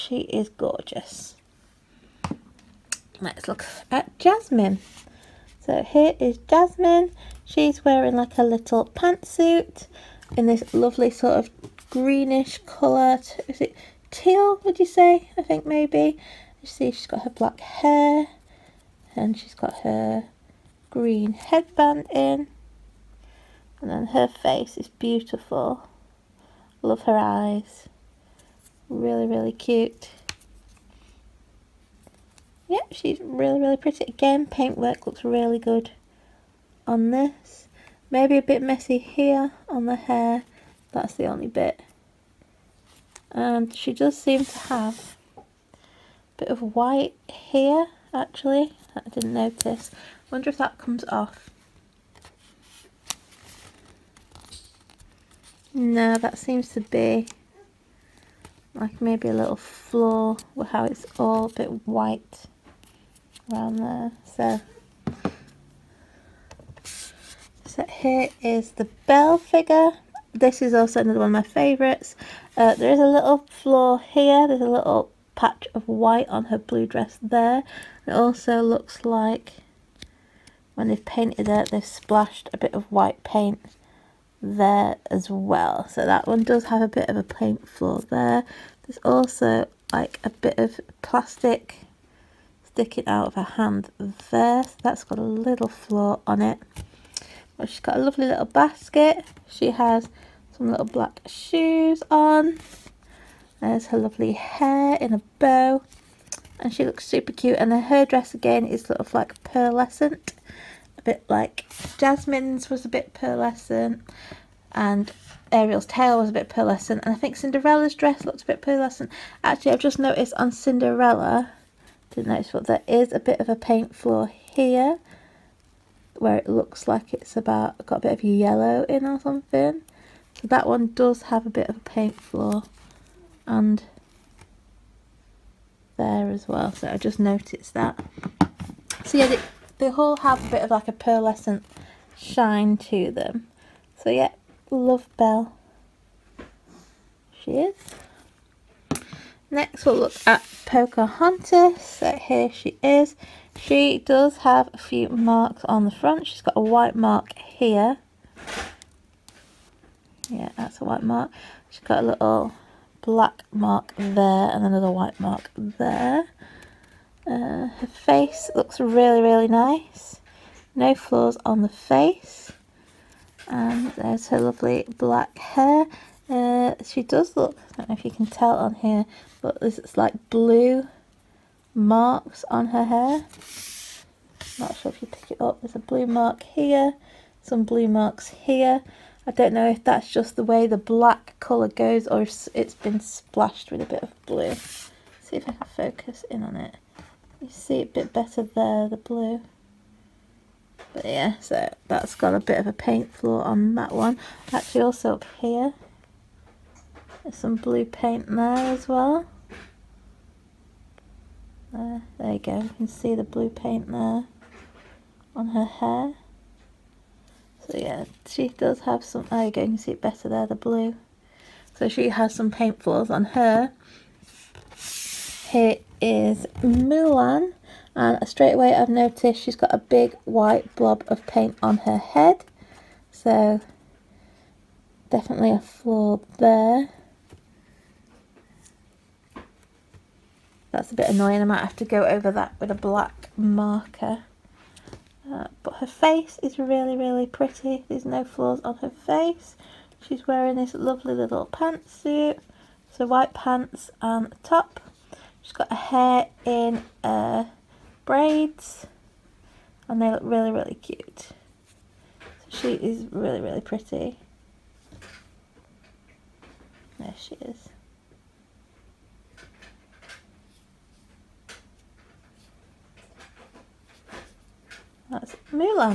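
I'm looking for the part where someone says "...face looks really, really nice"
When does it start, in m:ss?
2:47.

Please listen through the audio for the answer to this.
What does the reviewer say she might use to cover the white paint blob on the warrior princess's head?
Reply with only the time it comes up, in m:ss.
4:02.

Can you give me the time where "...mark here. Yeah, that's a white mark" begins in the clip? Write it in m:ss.
2:36.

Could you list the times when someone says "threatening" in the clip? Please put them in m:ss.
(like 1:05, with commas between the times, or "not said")
not said.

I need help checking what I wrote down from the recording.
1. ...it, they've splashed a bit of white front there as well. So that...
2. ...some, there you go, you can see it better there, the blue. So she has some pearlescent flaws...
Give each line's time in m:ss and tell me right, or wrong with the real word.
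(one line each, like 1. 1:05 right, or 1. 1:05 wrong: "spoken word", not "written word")
1. 1:21 wrong: "paint", not "front"
2. 3:39 wrong: "paint", not "pearlescent".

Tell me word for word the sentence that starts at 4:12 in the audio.
So white pants and a top.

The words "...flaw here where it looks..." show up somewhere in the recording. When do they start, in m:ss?
2:03.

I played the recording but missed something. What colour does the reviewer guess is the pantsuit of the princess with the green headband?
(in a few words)
teal.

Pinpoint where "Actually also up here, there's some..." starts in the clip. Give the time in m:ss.
3:24.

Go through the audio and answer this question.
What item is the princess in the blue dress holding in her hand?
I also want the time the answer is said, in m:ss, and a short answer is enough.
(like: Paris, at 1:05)
basket, at 1:38.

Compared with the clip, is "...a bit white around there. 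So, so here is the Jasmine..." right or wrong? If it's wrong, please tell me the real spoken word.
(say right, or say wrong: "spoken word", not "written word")
wrong: "Belle", not "Jasmine".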